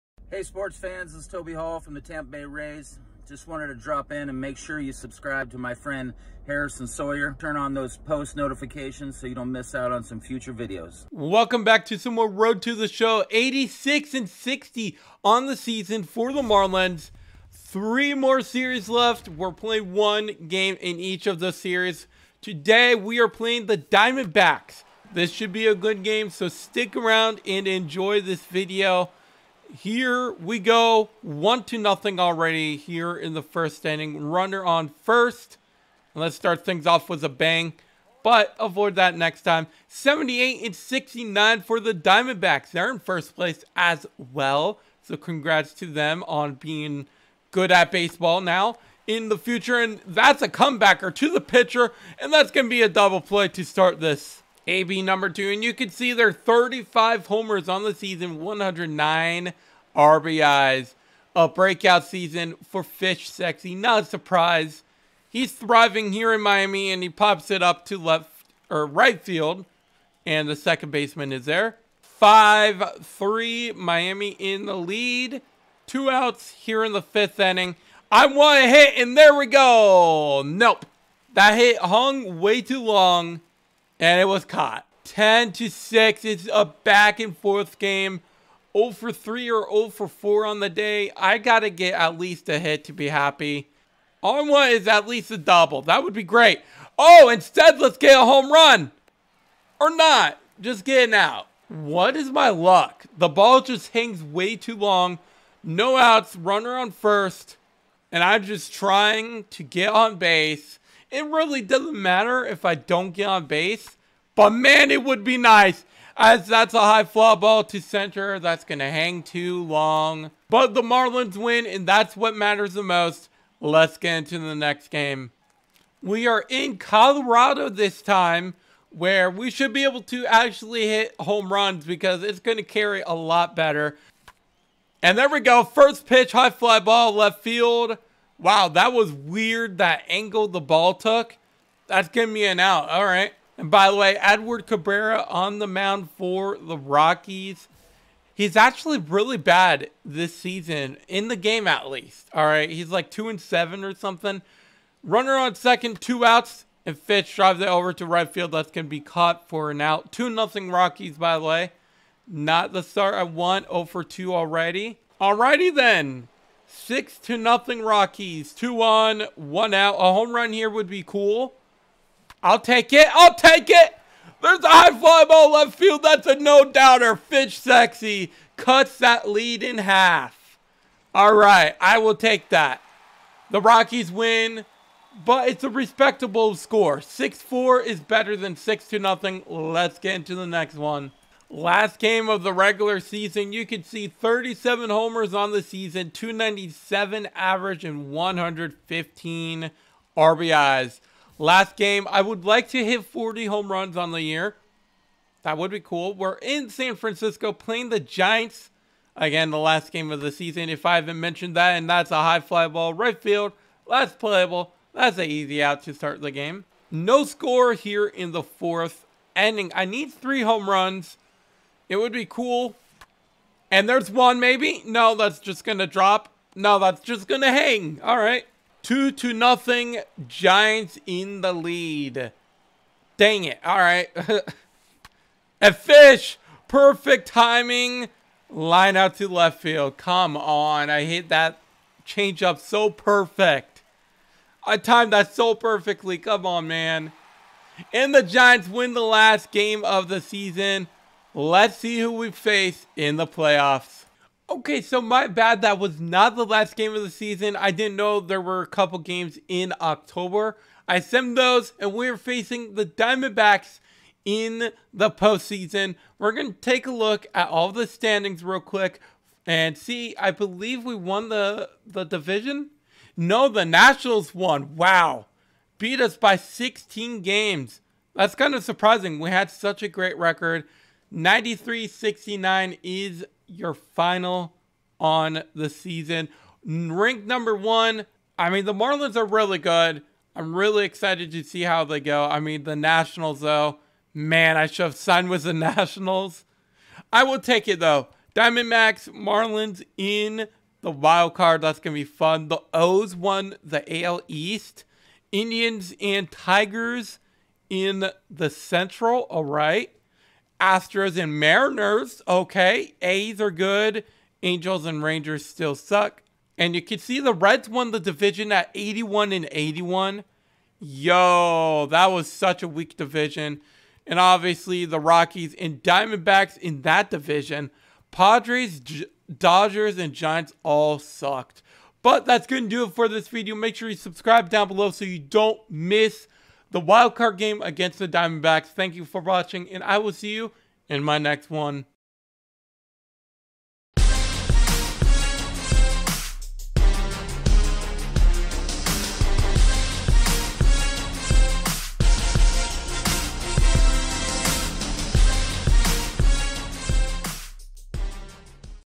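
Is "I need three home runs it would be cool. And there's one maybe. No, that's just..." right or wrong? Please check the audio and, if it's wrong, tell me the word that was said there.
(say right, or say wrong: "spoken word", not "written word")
right.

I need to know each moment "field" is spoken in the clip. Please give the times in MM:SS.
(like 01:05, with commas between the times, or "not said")
01:09, 02:17, 02:38, 02:55, 03:33, 03:59.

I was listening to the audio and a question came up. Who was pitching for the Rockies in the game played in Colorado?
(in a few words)
Edward Cabrera.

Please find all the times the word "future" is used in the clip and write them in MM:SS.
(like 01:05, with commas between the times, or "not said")
00:10, 00:49.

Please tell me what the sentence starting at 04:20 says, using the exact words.
I sent those, and we're facing the Diamondbacks in the postseason.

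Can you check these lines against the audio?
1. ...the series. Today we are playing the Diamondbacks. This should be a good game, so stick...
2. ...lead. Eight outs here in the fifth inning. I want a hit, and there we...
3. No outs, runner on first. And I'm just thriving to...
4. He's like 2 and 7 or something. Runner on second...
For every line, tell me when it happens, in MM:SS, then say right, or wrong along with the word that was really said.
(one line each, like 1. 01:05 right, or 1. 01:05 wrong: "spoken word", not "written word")
1. 00:21 right
2. 01:14 wrong: "Two", not "Eight"
3. 01:45 wrong: "trying", not "thriving"
4. 02:32 right.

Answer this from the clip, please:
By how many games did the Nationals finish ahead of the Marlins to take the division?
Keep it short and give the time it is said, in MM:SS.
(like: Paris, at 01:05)
16, at 04:35.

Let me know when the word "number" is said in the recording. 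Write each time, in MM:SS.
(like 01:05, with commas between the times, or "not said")
00:55, 04:47.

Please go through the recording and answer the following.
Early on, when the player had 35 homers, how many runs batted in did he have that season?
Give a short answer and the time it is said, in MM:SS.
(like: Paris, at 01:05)
109, at 00:58.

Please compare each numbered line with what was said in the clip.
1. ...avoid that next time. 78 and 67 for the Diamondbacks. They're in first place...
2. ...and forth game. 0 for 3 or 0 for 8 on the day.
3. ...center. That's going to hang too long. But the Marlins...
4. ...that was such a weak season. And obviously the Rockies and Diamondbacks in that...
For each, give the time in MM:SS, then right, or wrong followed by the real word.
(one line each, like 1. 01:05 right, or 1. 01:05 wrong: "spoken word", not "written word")
1. 00:38 wrong: "69", not "67"
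2. 01:27 wrong: "4", not "8"
3. 01:57 right
4. 05:21 wrong: "division", not "season".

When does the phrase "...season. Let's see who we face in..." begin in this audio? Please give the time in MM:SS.
04:10.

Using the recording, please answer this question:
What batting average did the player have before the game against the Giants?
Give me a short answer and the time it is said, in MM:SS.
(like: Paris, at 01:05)
297, at 03:16.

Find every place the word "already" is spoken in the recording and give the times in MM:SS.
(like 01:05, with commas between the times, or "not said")
00:32, 02:44.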